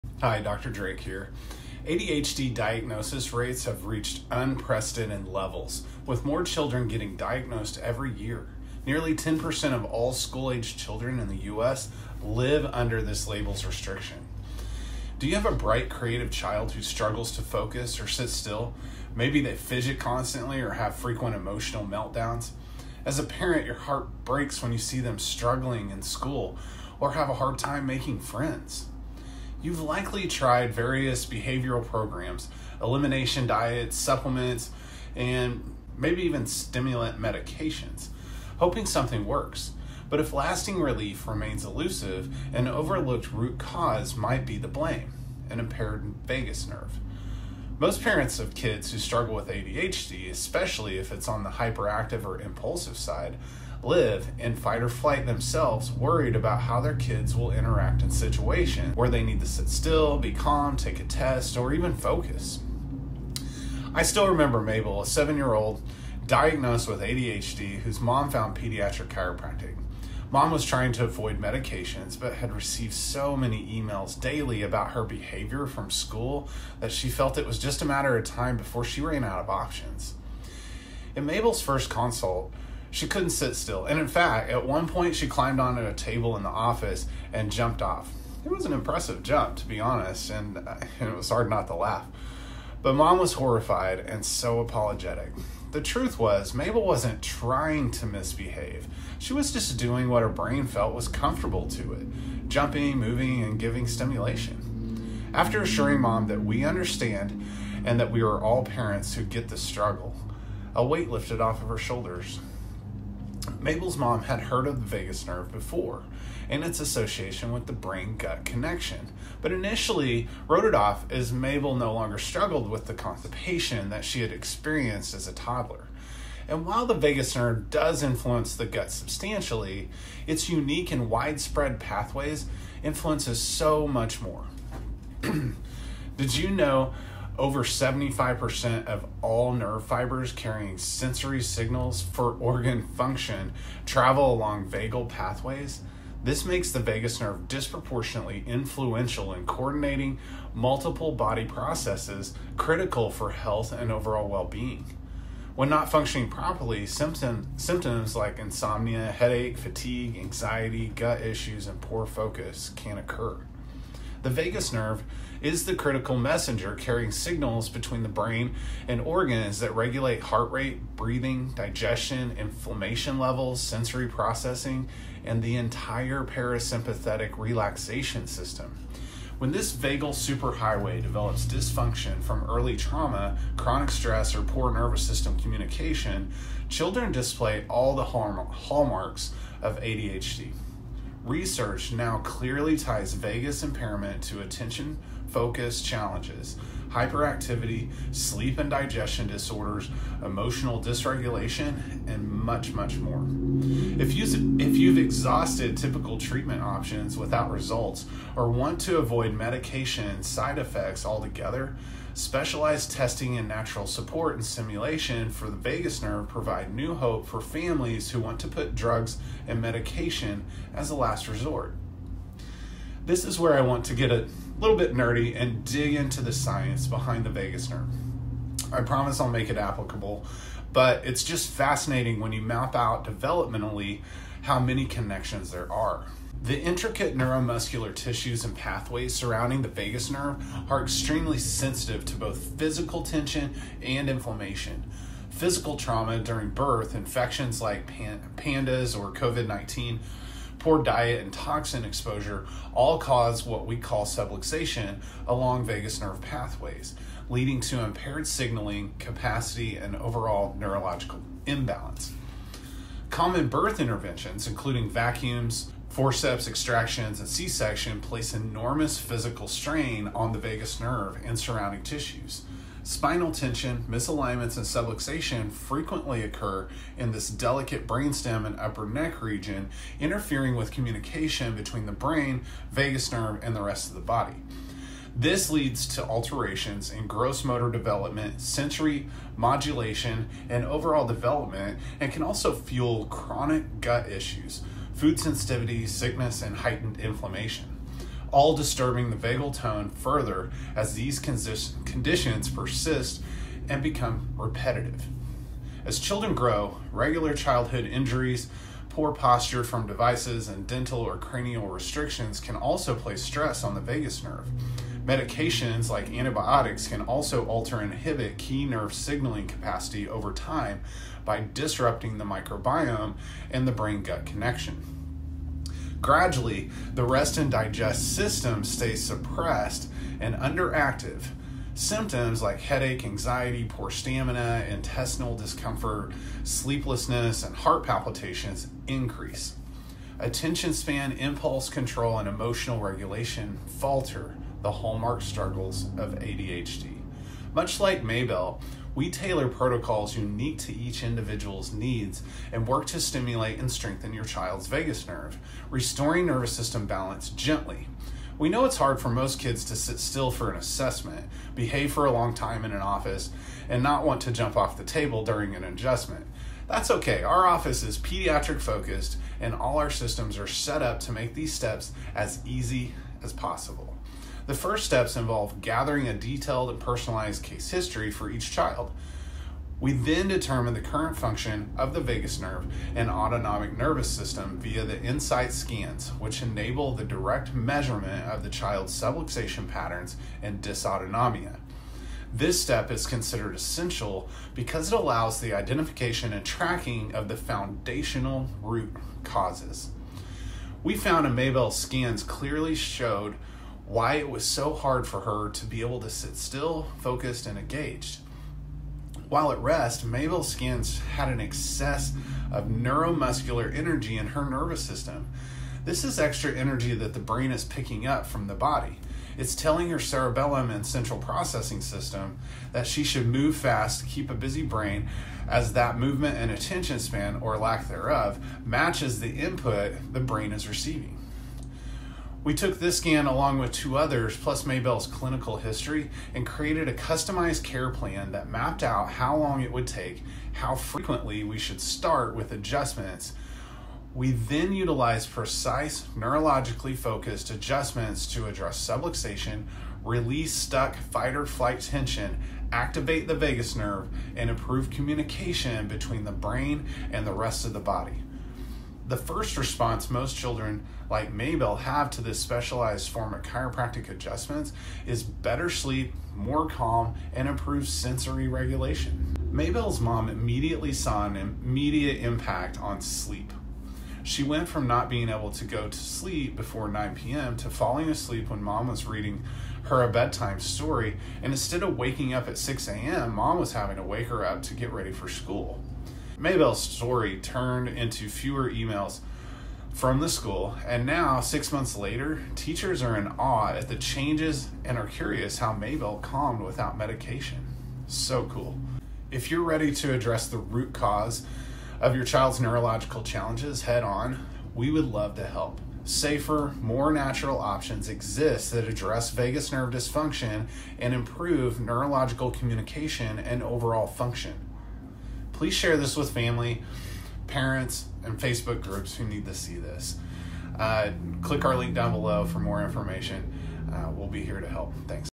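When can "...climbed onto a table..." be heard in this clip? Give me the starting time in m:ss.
1:25.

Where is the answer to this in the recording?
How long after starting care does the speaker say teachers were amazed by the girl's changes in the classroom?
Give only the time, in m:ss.
8:11.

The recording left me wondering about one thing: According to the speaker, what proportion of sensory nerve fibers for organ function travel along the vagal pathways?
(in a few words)
over 75%.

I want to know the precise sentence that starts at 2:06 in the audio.
And while the vagus nerve does influence the gut substantially, its unique and widespread pathways influences so much more.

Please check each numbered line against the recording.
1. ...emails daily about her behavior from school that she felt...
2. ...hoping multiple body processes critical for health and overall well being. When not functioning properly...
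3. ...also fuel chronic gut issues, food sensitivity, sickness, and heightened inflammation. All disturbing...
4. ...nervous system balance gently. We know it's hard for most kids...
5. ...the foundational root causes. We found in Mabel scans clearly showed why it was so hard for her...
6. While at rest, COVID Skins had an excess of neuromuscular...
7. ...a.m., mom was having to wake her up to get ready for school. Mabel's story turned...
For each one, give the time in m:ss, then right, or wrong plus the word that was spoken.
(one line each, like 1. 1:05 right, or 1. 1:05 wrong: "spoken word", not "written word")
1. 1:13 right
2. 2:29 wrong: "coordinating", not "hoping"
3. 4:52 right
4. 5:56 right
5. 6:37 right
6. 6:49 wrong: "Mabel", not "COVID"
7. 8:02 right.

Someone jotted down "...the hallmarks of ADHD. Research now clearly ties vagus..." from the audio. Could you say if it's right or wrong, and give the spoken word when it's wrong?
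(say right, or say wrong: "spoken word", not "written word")
right.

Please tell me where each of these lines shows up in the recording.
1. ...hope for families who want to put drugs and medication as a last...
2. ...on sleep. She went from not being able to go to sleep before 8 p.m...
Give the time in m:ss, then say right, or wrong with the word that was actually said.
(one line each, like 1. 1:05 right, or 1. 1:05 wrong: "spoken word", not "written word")
1. 3:36 right
2. 7:52 wrong: "9", not "8".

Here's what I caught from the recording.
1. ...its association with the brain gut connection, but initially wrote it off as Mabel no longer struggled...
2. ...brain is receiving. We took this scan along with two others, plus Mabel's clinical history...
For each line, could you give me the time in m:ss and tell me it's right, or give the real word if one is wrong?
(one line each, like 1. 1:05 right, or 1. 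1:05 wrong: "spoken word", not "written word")
1. 1:56 right
2. 7:10 right.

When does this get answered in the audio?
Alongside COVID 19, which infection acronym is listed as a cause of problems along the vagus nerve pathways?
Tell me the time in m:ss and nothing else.
4:08.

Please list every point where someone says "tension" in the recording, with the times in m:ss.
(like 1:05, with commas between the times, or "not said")
4:03, 4:33, 7:31.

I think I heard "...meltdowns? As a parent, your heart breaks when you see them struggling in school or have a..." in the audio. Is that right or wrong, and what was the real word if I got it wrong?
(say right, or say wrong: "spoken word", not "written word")
right.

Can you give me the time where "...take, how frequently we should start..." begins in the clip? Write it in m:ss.
7:19.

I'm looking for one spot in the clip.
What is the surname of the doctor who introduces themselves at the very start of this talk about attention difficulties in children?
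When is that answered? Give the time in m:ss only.
0:00.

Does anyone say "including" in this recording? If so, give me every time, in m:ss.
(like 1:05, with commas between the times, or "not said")
4:24.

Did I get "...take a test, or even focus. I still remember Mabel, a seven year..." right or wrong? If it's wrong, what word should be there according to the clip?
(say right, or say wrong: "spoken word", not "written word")
right.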